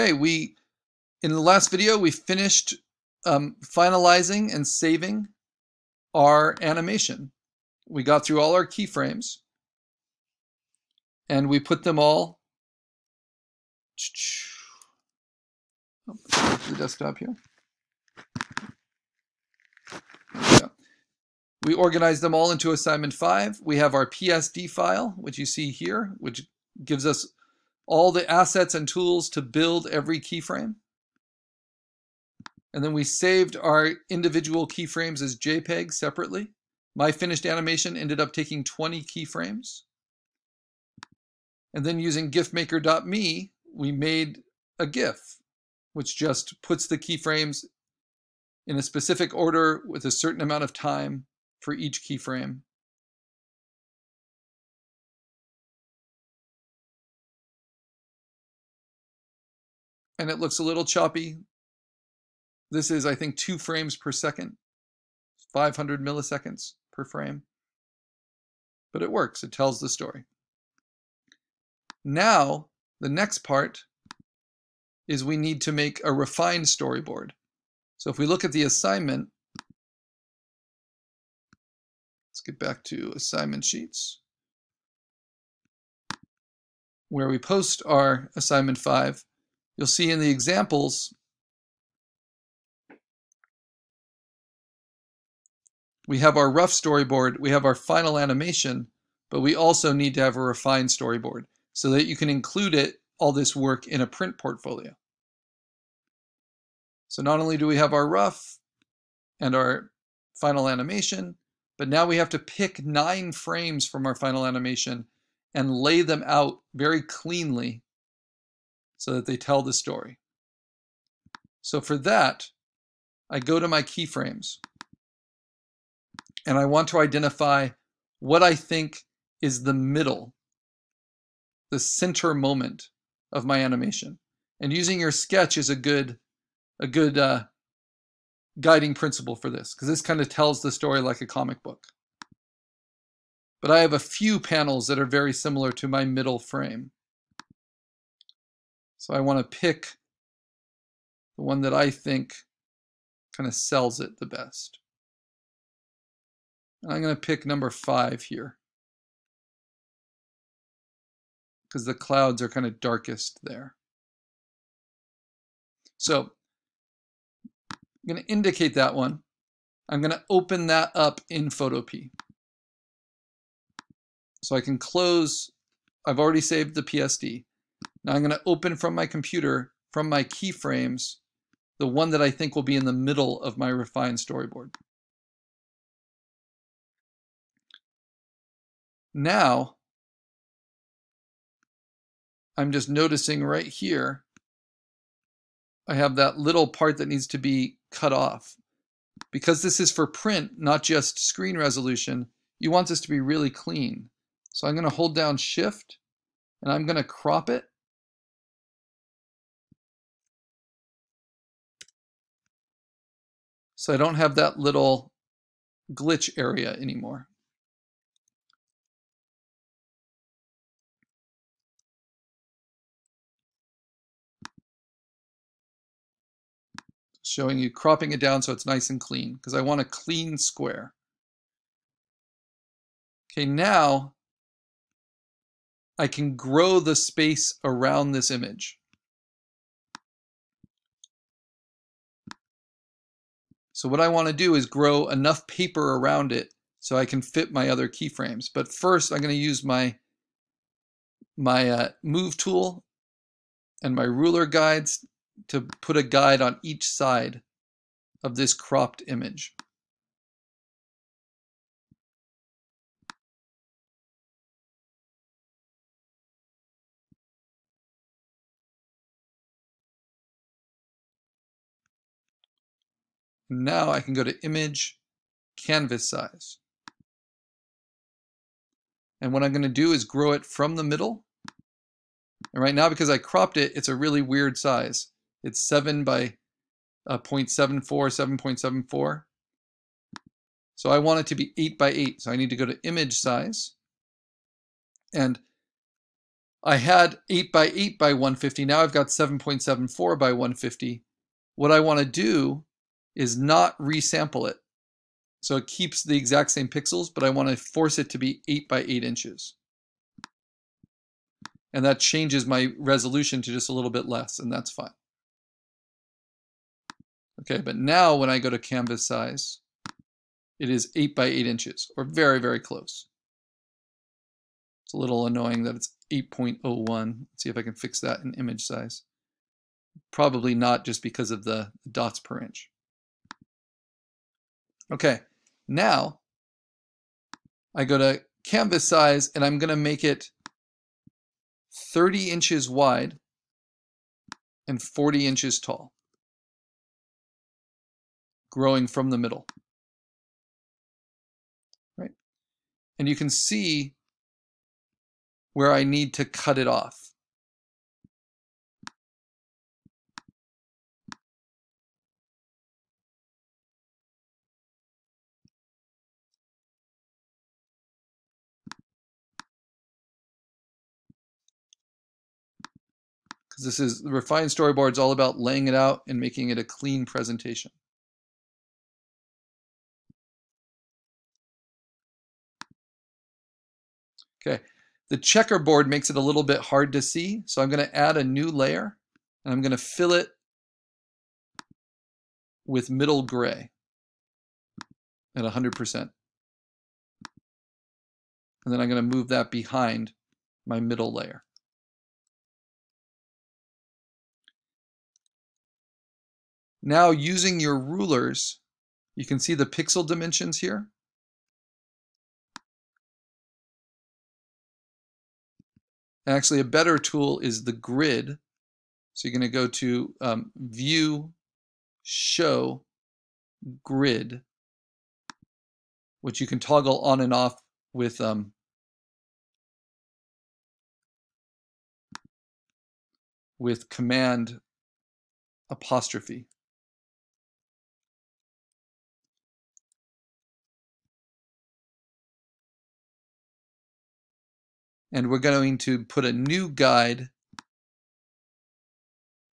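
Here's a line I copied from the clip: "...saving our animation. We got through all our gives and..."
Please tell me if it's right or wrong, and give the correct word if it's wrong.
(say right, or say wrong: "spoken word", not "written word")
wrong: "keyframes", not "gives".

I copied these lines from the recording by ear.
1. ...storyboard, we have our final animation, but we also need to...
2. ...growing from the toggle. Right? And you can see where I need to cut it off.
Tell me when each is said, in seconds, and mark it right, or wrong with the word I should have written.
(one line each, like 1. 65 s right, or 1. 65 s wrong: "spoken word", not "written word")
1. 96 s right
2. 348 s wrong: "middle", not "toggle".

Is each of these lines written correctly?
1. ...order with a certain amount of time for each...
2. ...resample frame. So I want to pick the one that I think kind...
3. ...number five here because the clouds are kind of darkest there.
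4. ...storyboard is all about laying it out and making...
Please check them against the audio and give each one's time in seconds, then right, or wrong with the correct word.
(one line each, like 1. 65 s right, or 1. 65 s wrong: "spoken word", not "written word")
1. 49 s right
2. 146 s wrong: "middle", not "resample"
3. 157 s right
4. 374 s right.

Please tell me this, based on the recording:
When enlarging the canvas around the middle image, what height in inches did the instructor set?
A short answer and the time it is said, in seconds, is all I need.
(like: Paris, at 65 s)
40 inches, at 344 s.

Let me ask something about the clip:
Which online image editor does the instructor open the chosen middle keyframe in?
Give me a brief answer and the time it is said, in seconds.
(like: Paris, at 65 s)
Photopea, at 171 s.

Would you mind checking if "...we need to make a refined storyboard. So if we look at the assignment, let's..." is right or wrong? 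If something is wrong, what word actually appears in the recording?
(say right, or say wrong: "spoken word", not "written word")
right.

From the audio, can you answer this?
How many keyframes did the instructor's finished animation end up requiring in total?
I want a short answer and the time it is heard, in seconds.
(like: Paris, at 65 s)
20, at 38 s.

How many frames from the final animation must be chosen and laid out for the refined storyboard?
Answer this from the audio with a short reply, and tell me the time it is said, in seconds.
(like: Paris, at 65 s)
9, at 112 s.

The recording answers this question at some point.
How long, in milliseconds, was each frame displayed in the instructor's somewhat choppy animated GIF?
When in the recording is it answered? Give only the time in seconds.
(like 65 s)
65 s.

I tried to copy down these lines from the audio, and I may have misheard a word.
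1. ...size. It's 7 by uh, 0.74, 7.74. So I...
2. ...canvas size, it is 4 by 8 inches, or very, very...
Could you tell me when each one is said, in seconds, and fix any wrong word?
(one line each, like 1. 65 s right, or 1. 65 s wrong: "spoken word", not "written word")
1. 284 s right
2. 318 s wrong: "8", not "4".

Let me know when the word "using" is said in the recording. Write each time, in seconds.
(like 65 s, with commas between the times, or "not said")
41 s, 134 s, 407 s.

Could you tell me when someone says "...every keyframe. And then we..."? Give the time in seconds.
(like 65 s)
29 s.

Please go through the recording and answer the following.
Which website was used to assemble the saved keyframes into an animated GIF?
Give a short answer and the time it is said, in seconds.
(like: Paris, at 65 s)
GIFmaker.me, at 42 s.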